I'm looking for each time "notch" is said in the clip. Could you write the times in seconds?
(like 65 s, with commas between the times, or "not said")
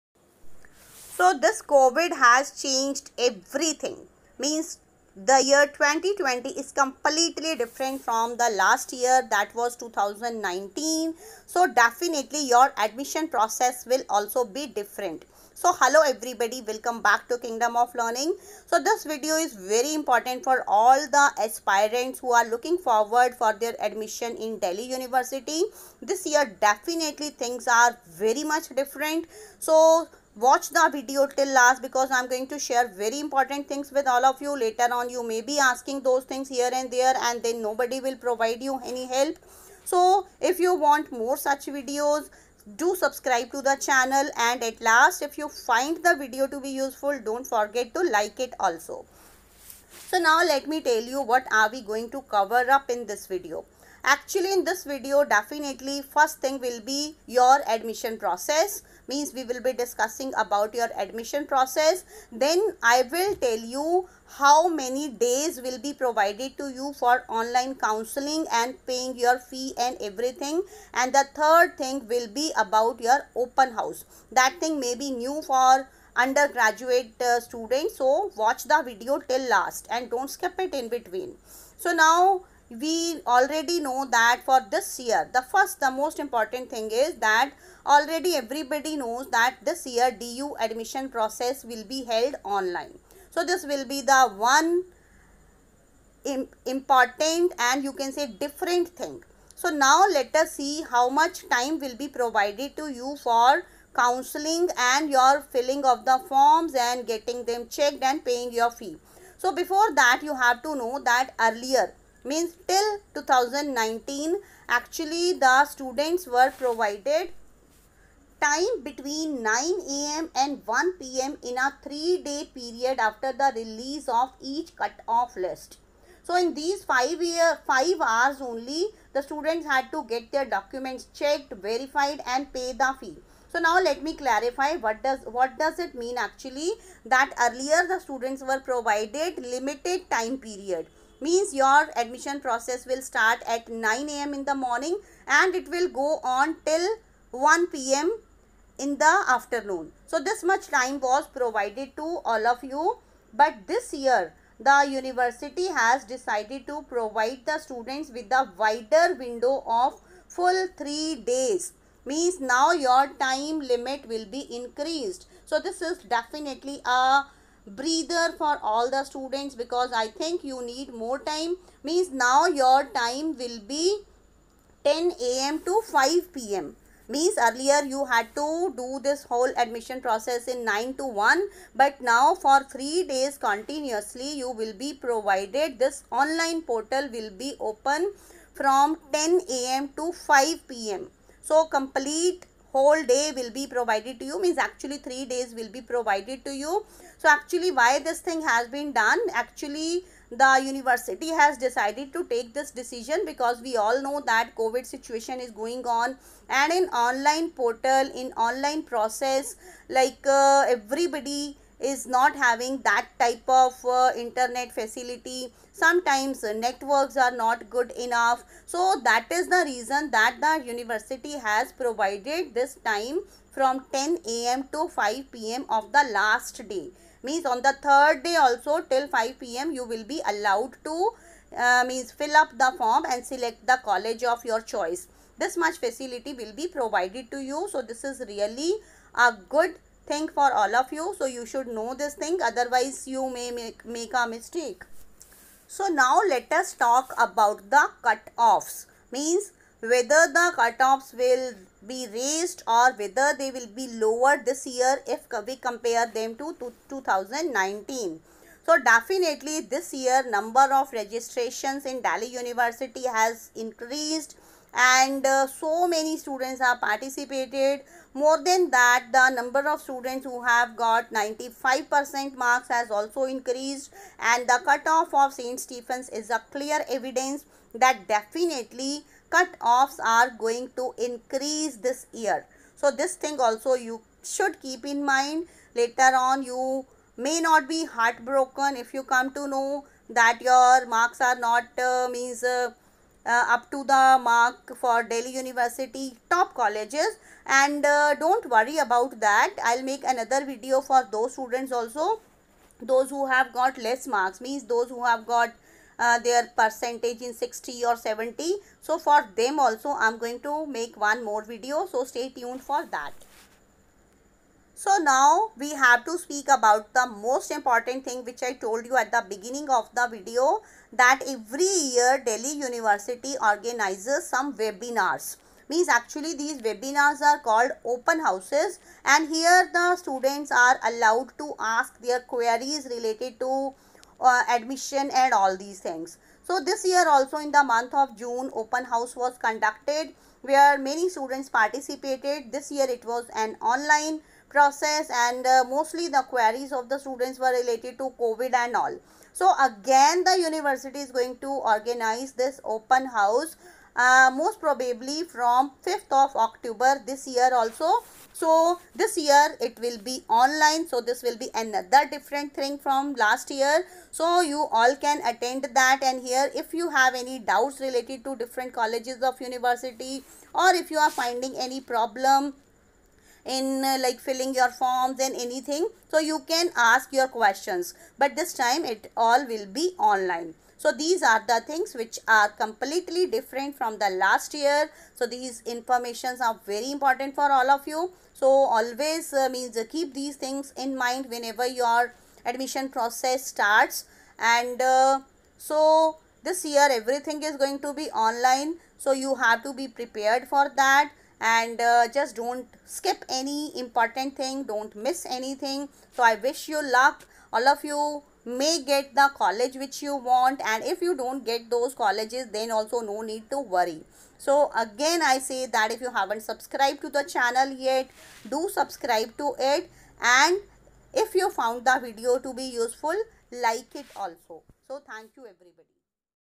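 not said.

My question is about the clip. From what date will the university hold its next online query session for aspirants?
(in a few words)
5th of October.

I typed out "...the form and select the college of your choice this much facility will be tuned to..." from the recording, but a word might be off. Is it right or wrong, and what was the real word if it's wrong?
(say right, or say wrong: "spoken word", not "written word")
wrong: "provided", not "tuned".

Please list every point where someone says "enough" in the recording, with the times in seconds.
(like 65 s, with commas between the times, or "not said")
217 s.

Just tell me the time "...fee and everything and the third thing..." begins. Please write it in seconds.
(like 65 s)
69 s.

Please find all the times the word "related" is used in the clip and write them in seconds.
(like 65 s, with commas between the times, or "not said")
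332 s, 347 s, 367 s.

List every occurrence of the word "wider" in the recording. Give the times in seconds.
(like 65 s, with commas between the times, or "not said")
158 s.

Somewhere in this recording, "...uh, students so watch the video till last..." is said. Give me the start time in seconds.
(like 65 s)
77 s.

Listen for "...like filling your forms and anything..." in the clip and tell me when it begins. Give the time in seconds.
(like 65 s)
374 s.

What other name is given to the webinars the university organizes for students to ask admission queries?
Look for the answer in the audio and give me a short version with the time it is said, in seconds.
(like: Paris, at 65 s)
open houses, at 327 s.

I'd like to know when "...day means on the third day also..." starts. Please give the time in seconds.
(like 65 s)
226 s.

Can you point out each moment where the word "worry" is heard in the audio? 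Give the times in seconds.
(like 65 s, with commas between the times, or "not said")
298 s, 413 s.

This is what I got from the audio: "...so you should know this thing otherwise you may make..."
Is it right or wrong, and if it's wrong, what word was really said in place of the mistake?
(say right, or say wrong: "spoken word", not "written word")
right.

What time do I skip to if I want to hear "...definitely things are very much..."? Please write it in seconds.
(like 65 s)
26 s.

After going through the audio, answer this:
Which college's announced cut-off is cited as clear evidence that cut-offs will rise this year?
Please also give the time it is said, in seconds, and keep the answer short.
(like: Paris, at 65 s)
St. Stephen's, at 275 s.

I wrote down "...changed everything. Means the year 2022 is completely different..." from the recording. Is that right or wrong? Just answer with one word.
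wrong.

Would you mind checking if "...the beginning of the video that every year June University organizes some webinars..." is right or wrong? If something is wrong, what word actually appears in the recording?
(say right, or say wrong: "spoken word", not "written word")
wrong: "Delhi", not "June".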